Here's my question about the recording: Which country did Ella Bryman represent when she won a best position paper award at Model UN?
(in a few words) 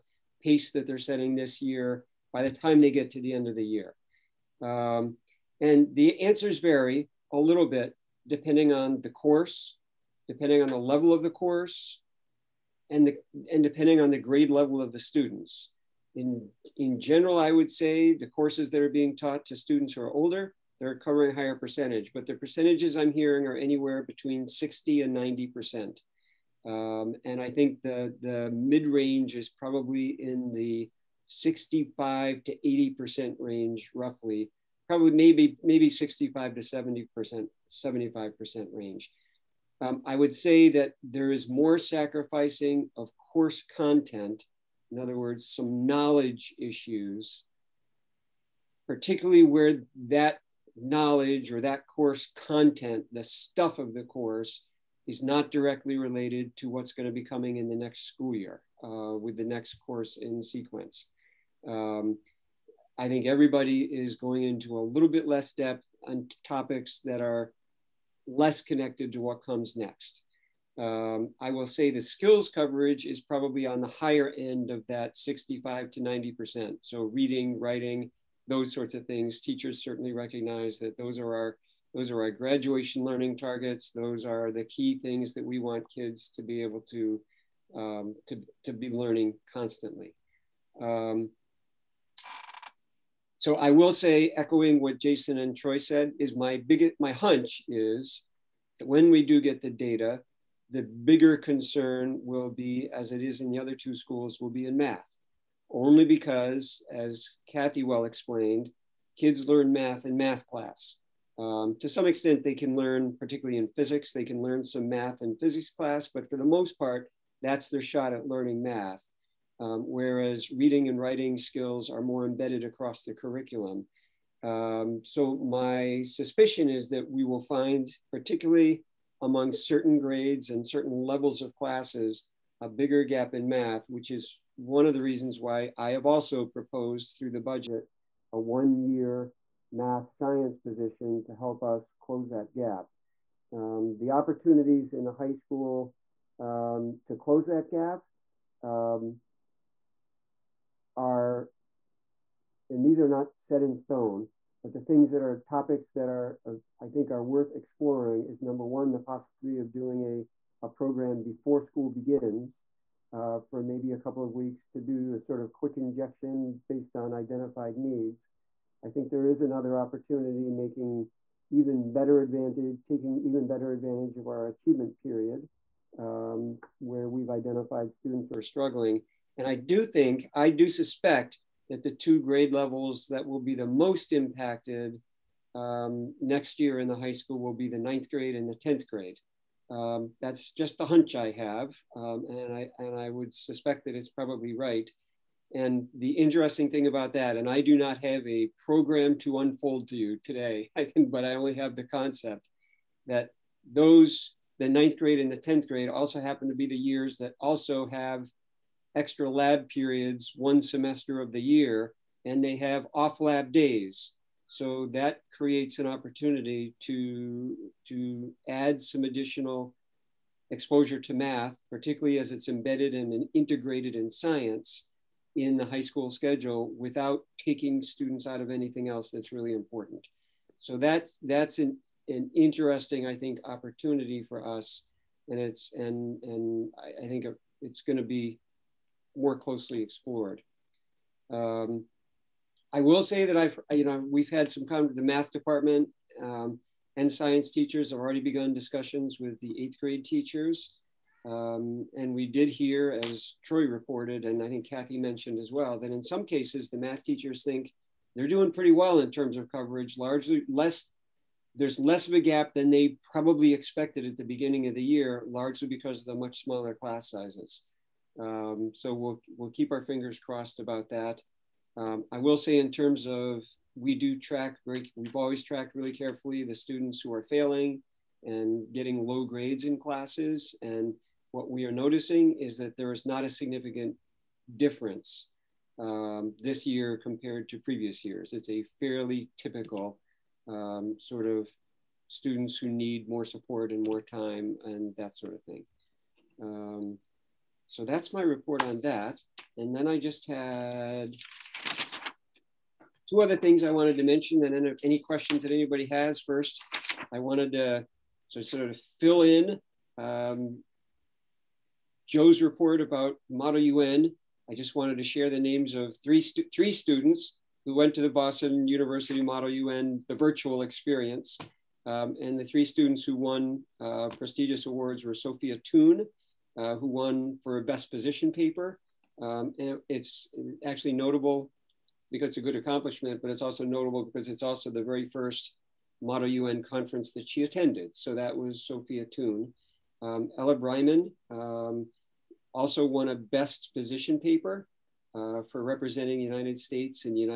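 United States.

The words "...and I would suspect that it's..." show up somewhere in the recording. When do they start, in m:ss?
3:12.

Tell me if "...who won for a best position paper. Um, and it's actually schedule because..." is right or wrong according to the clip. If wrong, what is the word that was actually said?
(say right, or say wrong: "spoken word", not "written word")
wrong: "notable", not "schedule".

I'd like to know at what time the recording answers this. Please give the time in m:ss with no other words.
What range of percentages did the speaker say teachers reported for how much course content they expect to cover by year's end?
0:24.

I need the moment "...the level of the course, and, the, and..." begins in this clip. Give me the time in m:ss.
0:10.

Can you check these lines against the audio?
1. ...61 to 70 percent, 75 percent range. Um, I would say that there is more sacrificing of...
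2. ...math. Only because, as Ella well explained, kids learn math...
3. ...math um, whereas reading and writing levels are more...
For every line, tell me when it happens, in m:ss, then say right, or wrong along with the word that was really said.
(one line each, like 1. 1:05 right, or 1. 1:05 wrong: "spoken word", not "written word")
1. 0:35 wrong: "65", not "61"
2. 1:44 wrong: "Kathy", not "Ella"
3. 1:58 wrong: "skills", not "levels".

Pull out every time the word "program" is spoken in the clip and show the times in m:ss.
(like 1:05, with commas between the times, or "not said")
2:40, 3:18.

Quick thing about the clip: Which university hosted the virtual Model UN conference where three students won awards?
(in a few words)
Boston University.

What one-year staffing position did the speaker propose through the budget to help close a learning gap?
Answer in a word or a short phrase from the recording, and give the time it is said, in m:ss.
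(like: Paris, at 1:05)
math science position, at 2:19.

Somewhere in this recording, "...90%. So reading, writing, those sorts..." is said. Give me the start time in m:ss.
1:16.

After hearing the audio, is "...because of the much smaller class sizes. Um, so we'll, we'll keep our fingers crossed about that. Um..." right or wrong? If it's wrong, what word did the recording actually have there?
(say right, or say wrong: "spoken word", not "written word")
right.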